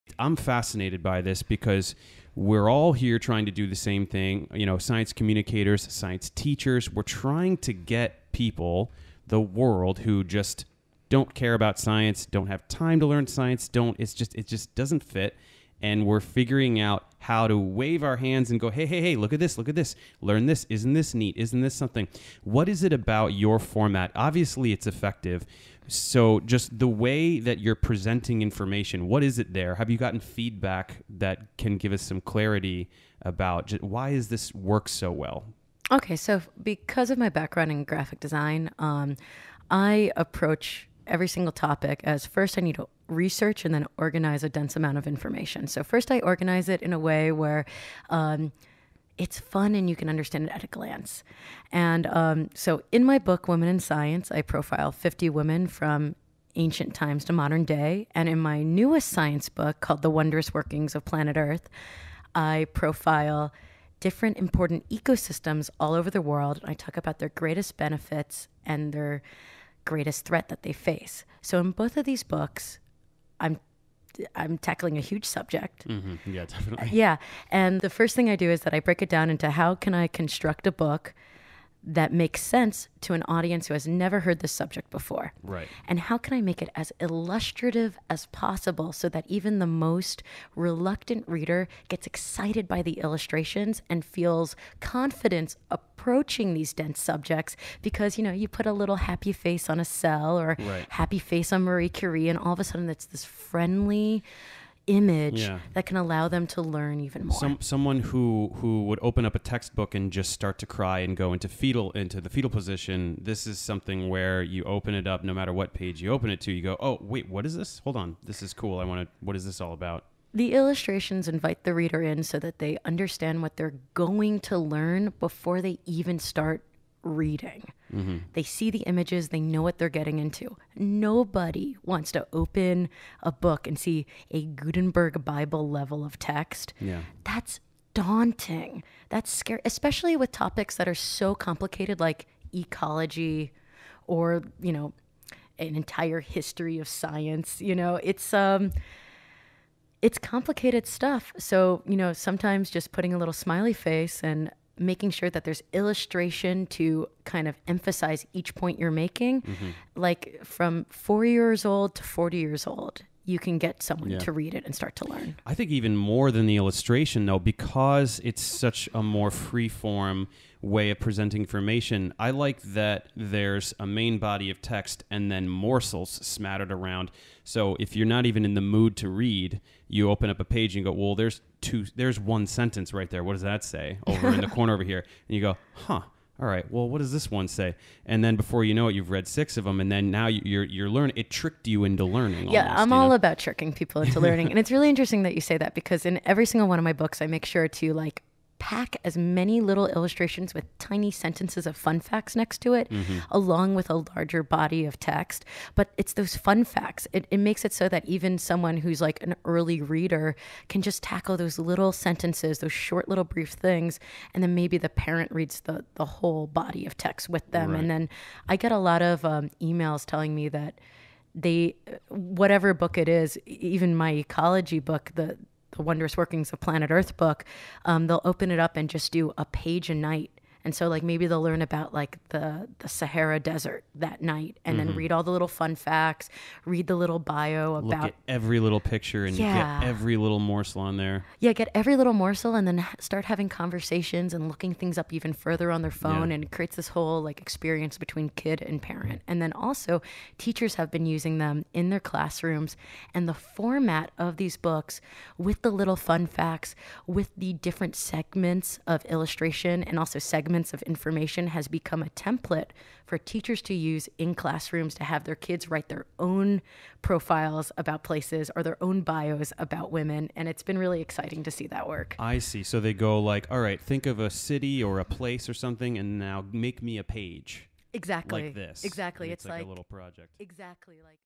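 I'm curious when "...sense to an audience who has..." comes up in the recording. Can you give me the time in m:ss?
1:22.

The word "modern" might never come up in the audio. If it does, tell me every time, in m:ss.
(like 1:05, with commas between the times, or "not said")
0:57.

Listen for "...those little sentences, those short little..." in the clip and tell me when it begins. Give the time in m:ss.
3:31.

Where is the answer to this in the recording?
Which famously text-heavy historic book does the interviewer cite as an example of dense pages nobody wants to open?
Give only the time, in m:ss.
2:14.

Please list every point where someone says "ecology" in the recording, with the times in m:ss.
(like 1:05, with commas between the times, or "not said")
2:22, 3:44.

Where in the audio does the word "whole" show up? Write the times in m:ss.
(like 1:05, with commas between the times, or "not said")
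3:36, 4:06.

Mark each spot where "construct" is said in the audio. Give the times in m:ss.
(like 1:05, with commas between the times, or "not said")
1:20.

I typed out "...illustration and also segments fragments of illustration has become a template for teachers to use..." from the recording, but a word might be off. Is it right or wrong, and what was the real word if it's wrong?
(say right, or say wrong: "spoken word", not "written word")
wrong: "information", not "illustration".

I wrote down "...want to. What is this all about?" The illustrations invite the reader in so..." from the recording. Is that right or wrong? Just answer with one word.
right.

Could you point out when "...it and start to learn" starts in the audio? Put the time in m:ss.
2:44.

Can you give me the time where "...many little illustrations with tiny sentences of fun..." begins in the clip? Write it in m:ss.
3:19.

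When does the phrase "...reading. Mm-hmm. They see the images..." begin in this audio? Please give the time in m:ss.
2:07.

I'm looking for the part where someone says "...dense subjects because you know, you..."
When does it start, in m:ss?
1:36.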